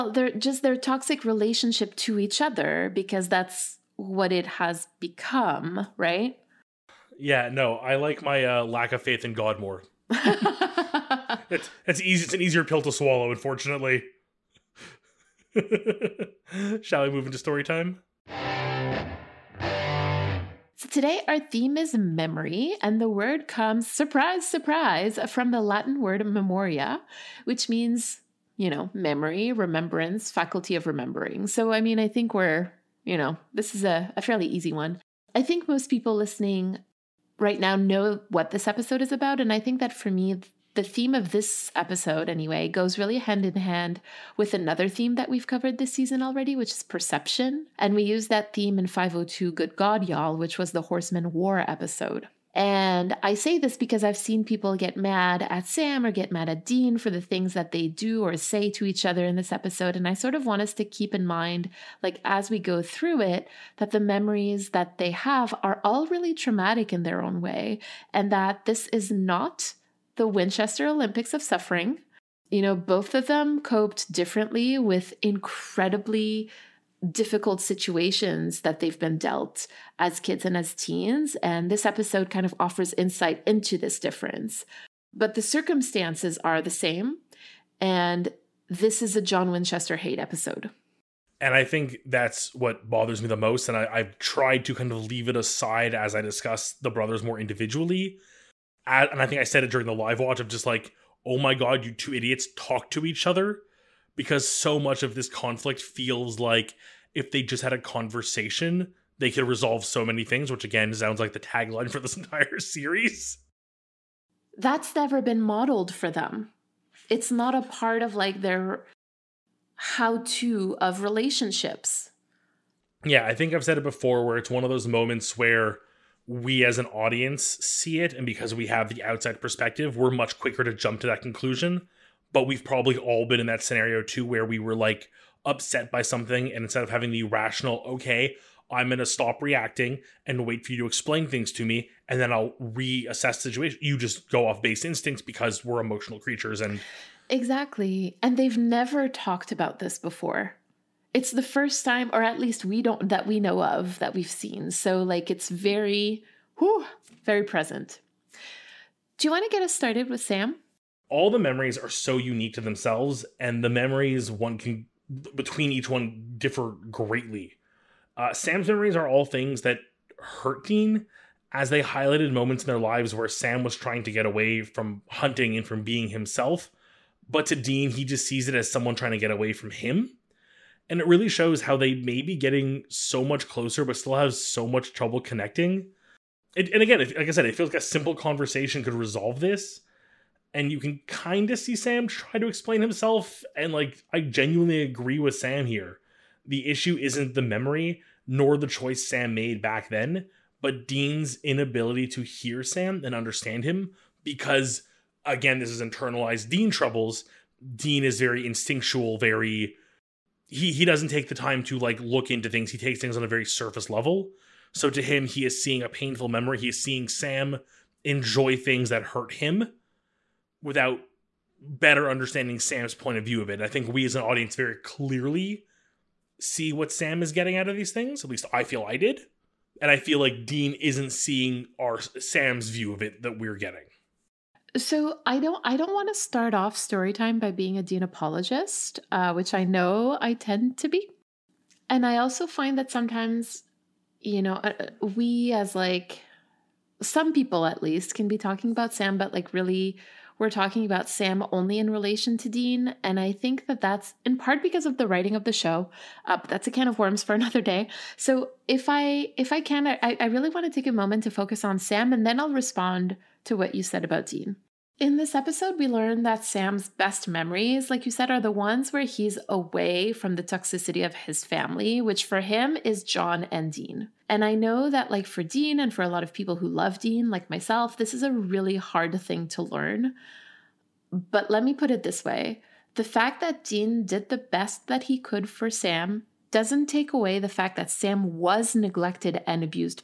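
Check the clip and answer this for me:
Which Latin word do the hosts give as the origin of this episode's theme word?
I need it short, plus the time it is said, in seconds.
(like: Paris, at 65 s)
memoria, at 26 s.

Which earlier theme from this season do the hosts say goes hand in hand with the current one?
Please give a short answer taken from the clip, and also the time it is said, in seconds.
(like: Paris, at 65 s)
perception, at 46 s.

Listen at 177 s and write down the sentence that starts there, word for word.
But to Dean, he just sees it as someone trying to get away from him.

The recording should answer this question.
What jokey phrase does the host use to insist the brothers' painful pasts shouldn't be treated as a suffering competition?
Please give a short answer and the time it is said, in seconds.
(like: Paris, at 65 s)
Winchester Olympics of Suffering, at 70 s.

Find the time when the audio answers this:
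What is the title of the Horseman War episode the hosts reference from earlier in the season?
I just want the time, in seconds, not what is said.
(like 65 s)
49 s.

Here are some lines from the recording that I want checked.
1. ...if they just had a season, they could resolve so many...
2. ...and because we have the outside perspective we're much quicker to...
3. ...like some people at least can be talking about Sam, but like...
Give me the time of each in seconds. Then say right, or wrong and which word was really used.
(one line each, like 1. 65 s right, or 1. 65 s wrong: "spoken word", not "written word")
1. 107 s wrong: "conversation", not "season"
2. 128 s right
3. 245 s right.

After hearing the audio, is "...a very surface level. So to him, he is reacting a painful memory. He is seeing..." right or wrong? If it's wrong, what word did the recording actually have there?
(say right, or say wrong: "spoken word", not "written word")
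wrong: "seeing", not "reacting".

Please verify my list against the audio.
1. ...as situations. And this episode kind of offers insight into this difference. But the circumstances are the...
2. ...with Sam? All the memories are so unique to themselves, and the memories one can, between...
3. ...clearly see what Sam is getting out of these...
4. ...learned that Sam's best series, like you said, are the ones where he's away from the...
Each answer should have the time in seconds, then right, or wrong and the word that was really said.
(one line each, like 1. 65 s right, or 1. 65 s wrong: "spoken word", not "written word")
1. 80 s wrong: "teens", not "situations"
2. 160 s right
3. 224 s right
4. 265 s wrong: "memories", not "series".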